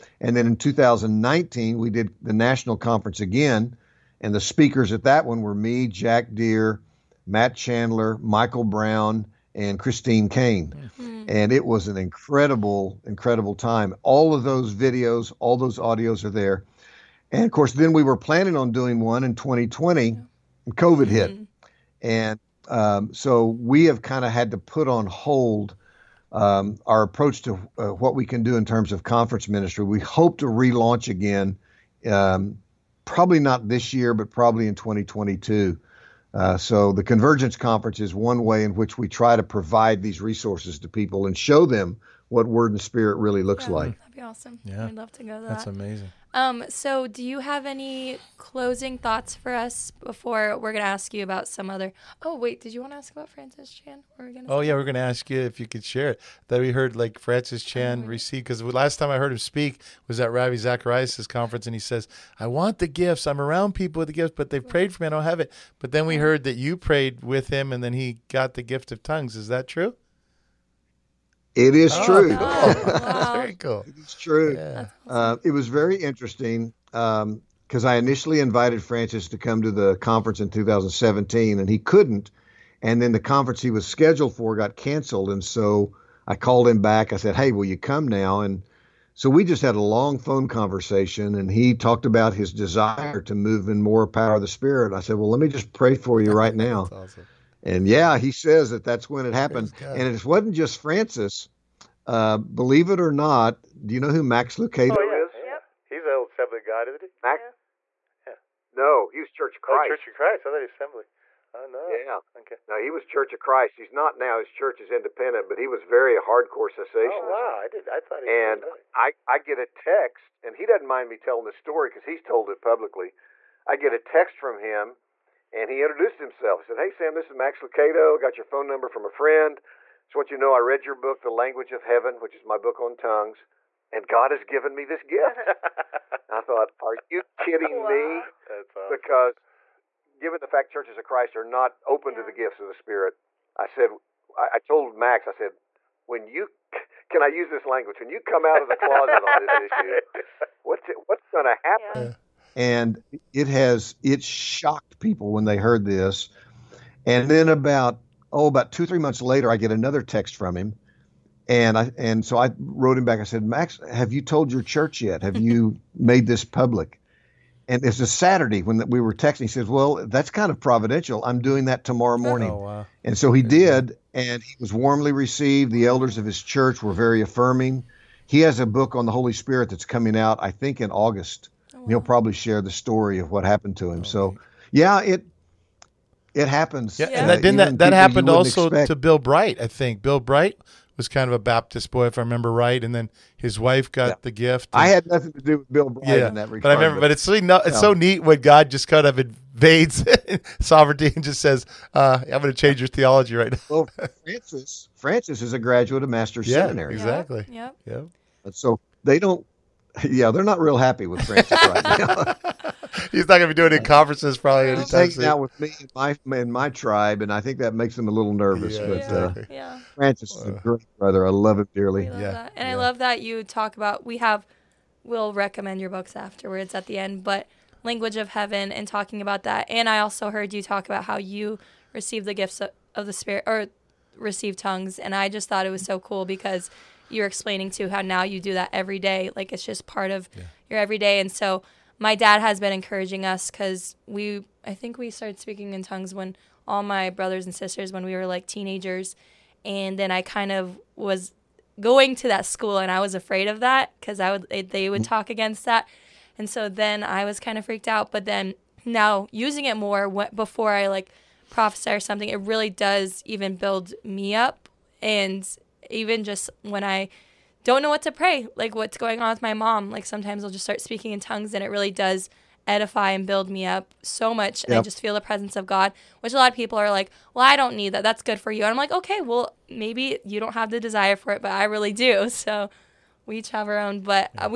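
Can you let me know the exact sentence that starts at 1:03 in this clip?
I'm around people with the gifts, but they've prayed for me.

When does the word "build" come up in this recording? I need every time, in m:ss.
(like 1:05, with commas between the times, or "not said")
4:23, 4:33.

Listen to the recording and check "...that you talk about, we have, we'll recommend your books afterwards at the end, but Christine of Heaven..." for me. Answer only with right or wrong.
wrong.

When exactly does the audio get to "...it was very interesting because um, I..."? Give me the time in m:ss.
1:15.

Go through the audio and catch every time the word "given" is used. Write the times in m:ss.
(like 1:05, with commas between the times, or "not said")
2:14, 2:20.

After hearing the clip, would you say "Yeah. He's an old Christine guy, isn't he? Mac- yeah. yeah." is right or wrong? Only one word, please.
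wrong.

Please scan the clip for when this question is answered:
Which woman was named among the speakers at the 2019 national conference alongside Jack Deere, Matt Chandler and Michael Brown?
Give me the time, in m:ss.
0:09.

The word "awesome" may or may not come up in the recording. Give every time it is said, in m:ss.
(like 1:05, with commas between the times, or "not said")
0:44, 1:36, 2:18.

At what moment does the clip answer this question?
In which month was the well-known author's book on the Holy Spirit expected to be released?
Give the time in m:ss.
3:00.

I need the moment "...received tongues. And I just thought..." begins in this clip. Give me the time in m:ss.
3:54.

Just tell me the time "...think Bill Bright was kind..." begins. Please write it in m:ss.
3:09.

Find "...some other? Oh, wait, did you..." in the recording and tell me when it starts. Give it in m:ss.
0:51.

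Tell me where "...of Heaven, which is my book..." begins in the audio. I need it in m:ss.
2:11.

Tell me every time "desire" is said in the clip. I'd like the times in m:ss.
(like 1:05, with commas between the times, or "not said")
1:32, 4:40.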